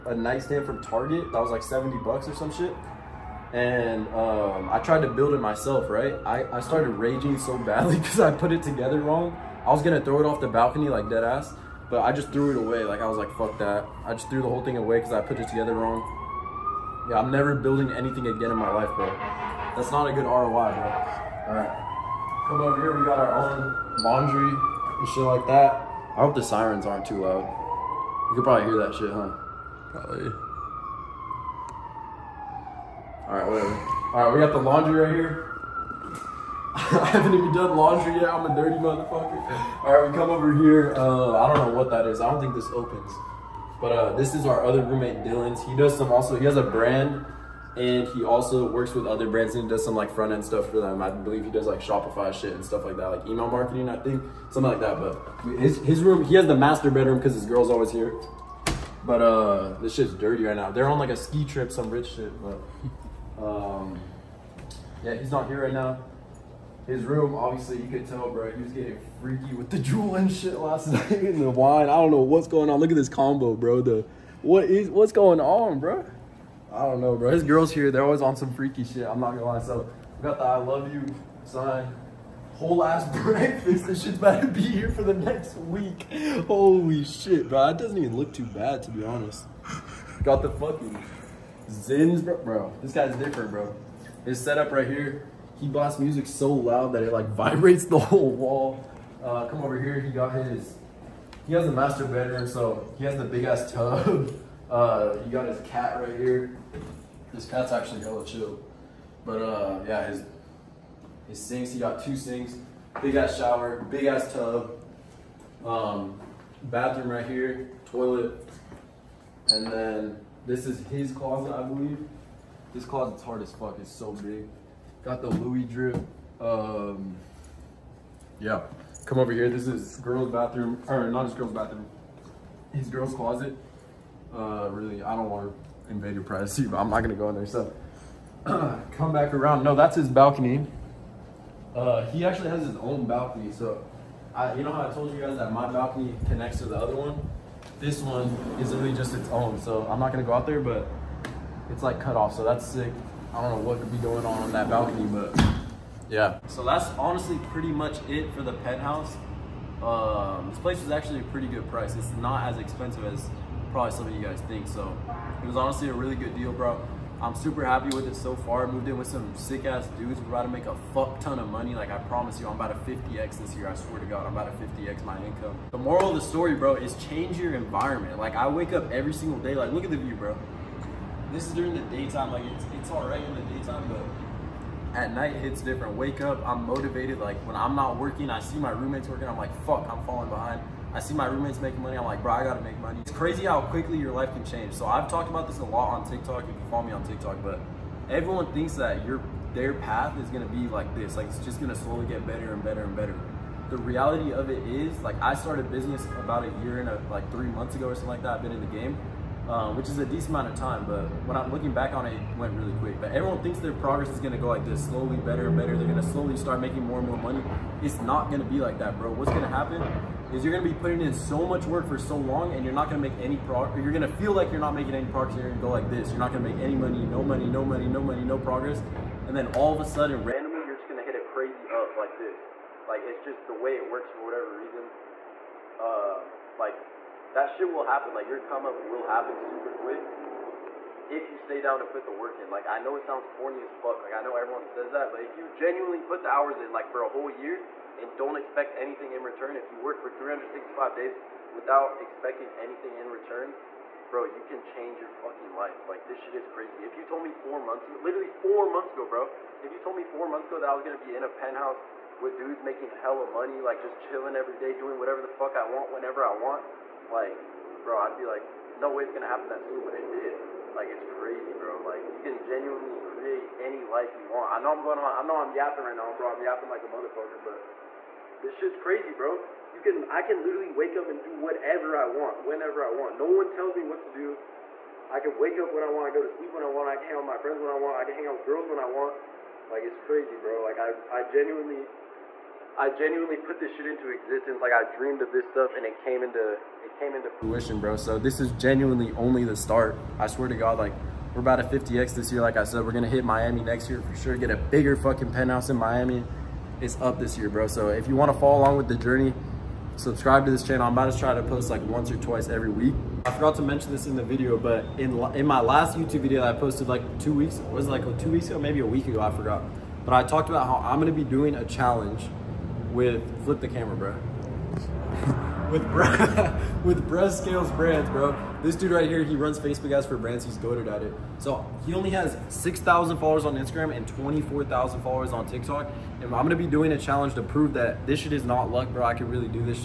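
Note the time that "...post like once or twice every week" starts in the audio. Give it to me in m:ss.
5:11.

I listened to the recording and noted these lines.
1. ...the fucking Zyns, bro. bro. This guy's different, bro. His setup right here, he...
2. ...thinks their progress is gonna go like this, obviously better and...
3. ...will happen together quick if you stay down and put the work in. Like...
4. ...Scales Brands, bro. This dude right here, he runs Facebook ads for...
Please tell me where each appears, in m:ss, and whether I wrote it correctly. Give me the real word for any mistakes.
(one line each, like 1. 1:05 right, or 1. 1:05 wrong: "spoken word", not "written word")
1. 1:30 right
2. 3:33 wrong: "slowly", not "obviously"
3. 3:58 wrong: "super", not "together"
4. 5:27 right.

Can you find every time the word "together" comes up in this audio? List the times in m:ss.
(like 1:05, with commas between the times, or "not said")
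0:08, 0:15.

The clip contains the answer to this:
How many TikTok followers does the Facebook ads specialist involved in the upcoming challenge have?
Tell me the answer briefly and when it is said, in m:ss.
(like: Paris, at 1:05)
24,000, at 5:34.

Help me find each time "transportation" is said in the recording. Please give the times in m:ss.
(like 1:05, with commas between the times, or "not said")
not said.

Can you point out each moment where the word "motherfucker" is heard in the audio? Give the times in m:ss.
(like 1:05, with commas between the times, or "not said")
0:38, 4:36.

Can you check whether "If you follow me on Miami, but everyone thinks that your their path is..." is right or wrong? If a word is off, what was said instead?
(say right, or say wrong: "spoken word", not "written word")
wrong: "TikTok", not "Miami".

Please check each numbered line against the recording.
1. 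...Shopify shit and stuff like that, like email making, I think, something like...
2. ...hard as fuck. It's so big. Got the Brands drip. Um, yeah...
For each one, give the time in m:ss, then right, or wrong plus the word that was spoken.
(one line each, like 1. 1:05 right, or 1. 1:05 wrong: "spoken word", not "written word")
1. 0:51 wrong: "marketing", not "making"
2. 2:03 wrong: "Louis", not "Brands".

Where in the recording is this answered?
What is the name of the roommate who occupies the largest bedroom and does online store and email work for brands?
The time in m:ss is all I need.
0:45.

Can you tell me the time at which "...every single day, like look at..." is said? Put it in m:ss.
2:58.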